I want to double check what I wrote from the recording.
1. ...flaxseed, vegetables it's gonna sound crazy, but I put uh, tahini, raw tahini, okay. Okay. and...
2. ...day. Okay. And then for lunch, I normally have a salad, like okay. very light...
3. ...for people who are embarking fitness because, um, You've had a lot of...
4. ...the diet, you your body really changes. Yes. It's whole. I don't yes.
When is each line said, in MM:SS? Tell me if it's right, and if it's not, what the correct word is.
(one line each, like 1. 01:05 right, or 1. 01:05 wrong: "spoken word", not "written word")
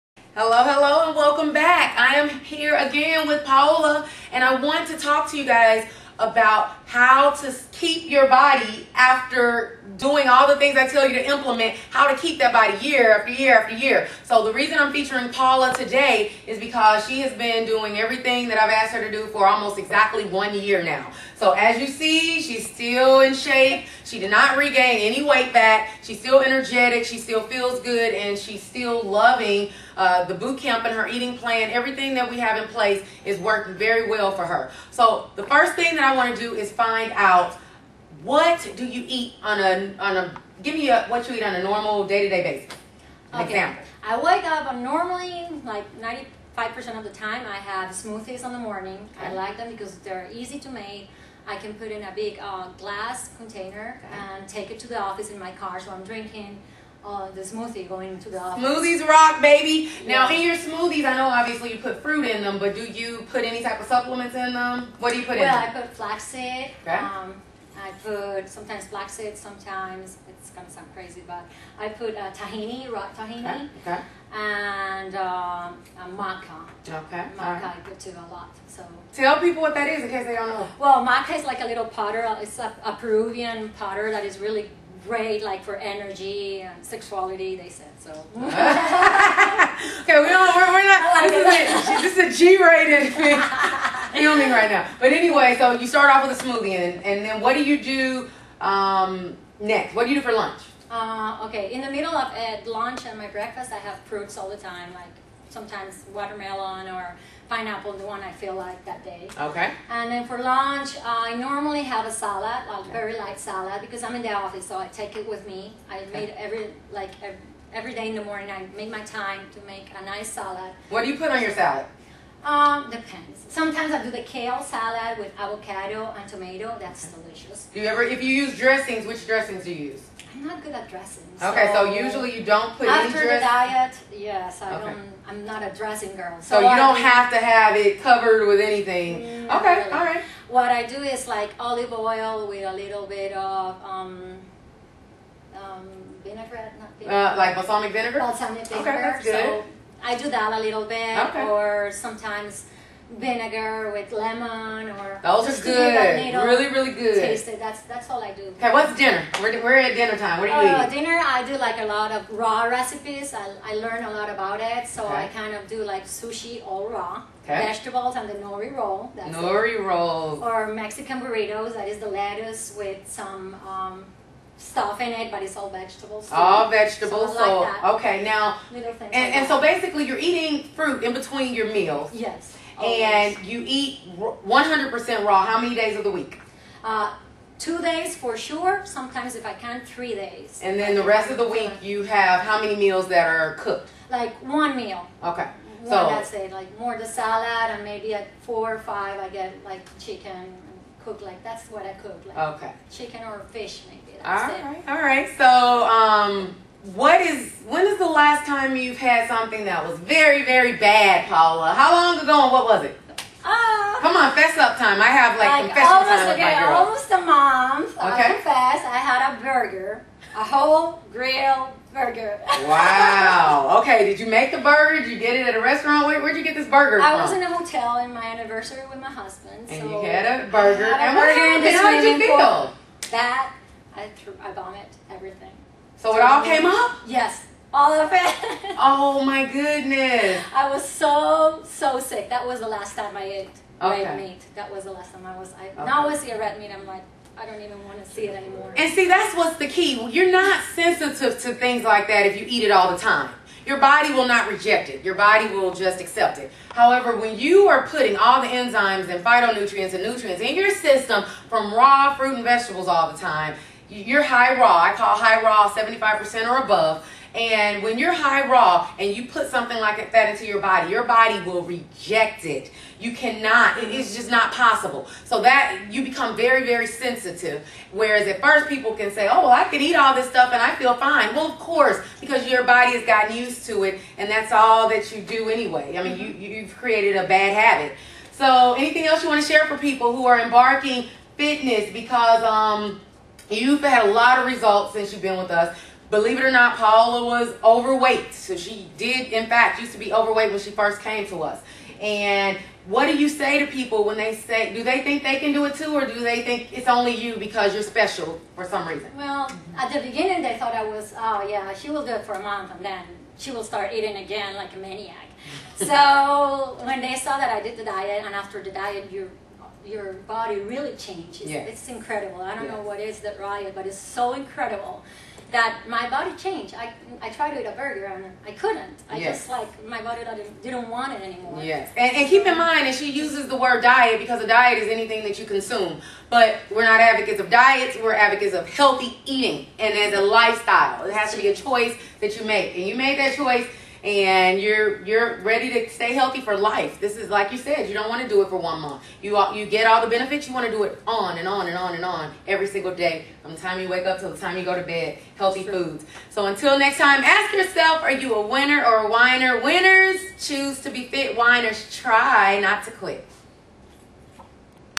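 1. 01:08 wrong: "sometimes", not "vegetables"
2. 01:49 right
3. 04:49 right
4. 05:18 wrong: "incredible", not "whole".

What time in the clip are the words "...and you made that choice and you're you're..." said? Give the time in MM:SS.
05:42.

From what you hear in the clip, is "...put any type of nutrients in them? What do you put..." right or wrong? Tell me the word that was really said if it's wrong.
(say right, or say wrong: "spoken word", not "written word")
wrong: "supplements", not "nutrients".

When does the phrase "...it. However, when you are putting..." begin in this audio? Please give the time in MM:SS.
04:16.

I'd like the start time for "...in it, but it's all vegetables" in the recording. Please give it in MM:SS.
02:55.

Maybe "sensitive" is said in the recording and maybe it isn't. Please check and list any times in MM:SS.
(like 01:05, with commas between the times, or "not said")
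04:10, 04:36.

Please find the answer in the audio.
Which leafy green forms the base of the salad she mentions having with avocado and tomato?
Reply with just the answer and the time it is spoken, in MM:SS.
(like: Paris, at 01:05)
Kale, at 02:04.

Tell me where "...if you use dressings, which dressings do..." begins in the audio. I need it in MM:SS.
02:08.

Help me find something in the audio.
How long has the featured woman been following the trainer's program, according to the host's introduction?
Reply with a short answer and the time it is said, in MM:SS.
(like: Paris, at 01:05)
Almost 1 year, at 00:19.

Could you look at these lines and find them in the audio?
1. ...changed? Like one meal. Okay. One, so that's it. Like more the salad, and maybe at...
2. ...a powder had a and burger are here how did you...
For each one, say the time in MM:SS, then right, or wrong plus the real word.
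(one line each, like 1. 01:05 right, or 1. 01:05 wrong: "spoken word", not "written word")
1. 03:13 wrong: "cooked", not "changed"
2. 03:50 wrong: "burger", not "powder".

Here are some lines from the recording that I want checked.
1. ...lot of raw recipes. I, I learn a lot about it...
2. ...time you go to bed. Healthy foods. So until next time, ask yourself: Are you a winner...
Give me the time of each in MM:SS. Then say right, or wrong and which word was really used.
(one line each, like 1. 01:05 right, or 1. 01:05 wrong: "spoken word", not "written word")
1. 02:41 right
2. 05:54 right.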